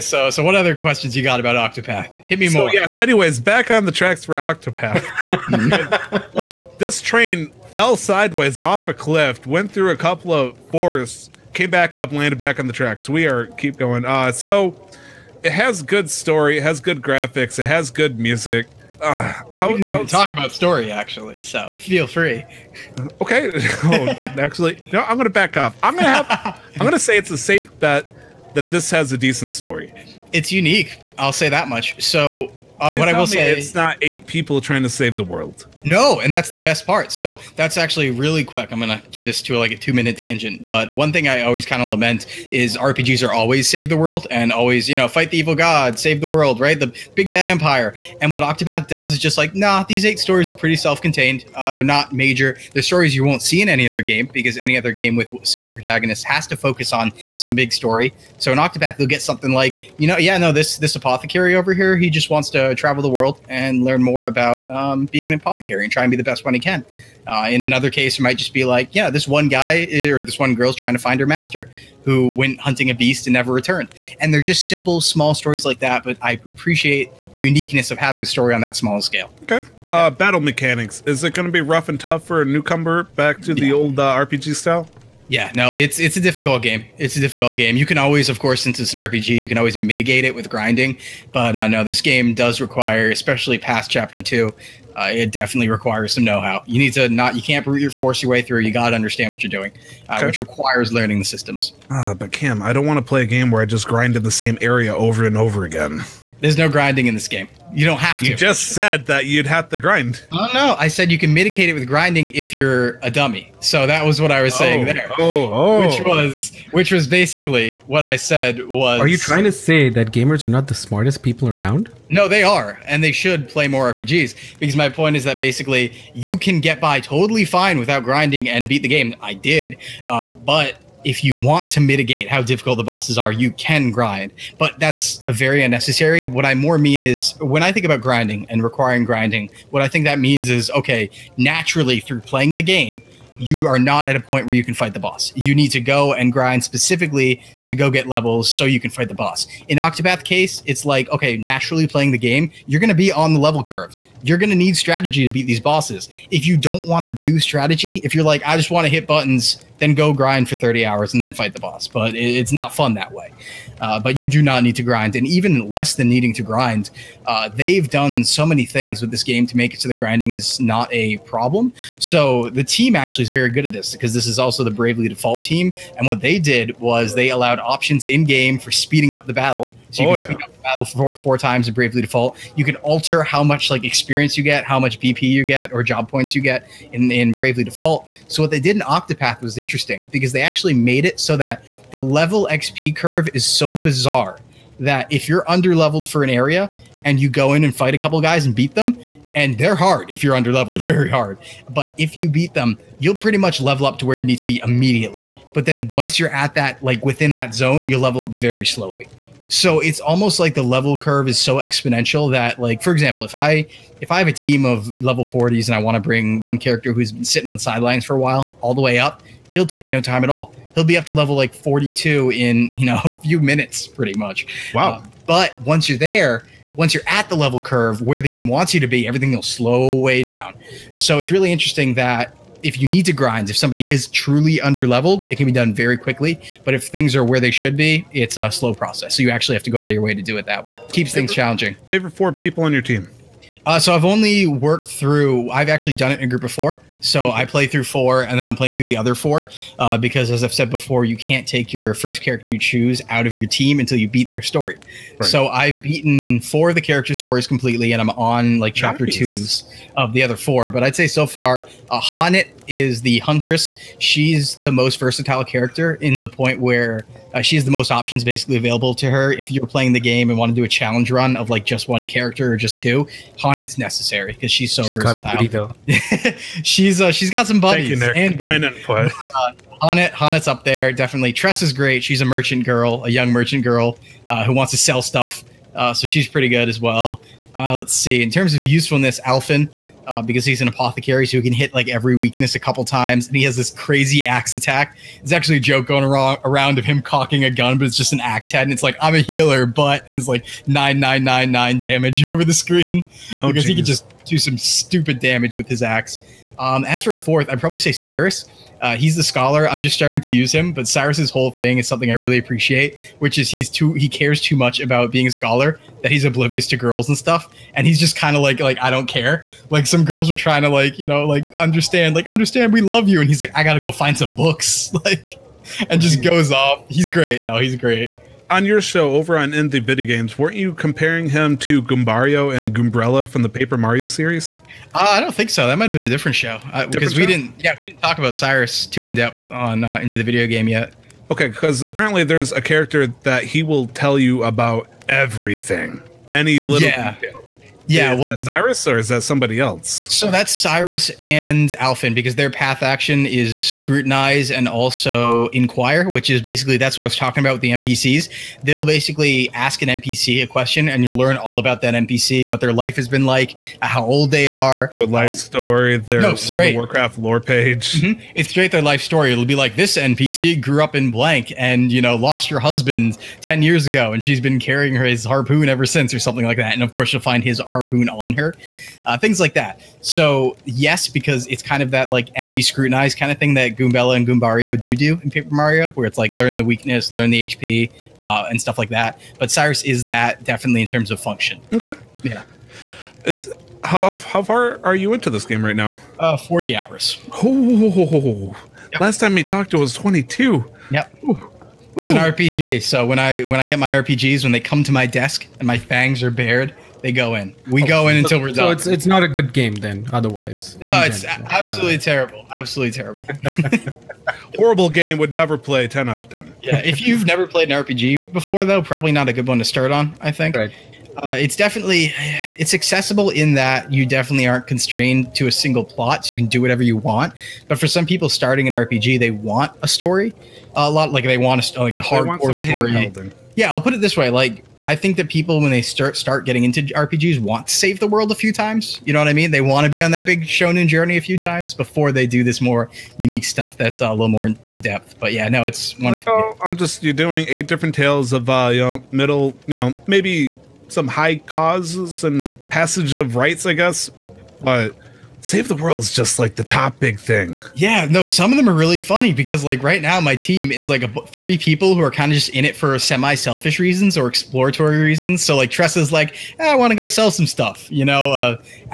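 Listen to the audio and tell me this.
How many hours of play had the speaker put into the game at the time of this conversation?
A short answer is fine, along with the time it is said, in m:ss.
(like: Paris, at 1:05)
40 hours, at 6:36.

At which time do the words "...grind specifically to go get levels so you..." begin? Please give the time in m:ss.
2:26.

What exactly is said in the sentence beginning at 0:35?
No, and that's the best part.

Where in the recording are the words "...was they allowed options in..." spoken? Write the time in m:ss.
2:56.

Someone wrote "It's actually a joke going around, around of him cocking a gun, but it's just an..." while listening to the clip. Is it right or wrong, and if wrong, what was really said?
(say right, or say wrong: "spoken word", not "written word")
right.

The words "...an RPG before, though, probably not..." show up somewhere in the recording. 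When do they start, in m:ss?
6:57.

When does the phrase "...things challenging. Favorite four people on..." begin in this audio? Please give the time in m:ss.
4:01.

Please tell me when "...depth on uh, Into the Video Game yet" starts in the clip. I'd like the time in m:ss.
5:39.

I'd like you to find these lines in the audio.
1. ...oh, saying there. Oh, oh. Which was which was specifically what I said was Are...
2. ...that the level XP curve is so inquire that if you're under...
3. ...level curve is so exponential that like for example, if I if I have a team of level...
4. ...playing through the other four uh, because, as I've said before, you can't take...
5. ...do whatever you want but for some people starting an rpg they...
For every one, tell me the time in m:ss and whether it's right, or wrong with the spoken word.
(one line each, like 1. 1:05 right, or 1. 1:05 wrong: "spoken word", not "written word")
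1. 1:54 wrong: "basically", not "specifically"
2. 3:11 wrong: "bizarre", not "inquire"
3. 3:30 right
4. 4:08 right
5. 7:06 right.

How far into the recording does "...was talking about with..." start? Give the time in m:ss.
5:57.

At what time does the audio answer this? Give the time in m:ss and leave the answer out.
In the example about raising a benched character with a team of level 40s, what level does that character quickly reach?
3:41.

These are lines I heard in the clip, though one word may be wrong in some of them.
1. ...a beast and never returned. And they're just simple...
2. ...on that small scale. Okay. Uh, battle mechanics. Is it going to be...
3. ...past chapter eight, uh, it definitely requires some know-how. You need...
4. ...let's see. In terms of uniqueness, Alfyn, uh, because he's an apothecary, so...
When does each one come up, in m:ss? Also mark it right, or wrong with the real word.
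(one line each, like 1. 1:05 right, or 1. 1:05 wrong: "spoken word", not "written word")
1. 1:12 right
2. 1:18 right
3. 1:33 wrong: "two", not "eight"
4. 4:47 wrong: "usefulness", not "uniqueness".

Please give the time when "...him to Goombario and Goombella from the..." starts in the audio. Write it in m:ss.
5:31.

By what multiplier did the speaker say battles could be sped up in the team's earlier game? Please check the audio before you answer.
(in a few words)
4 times.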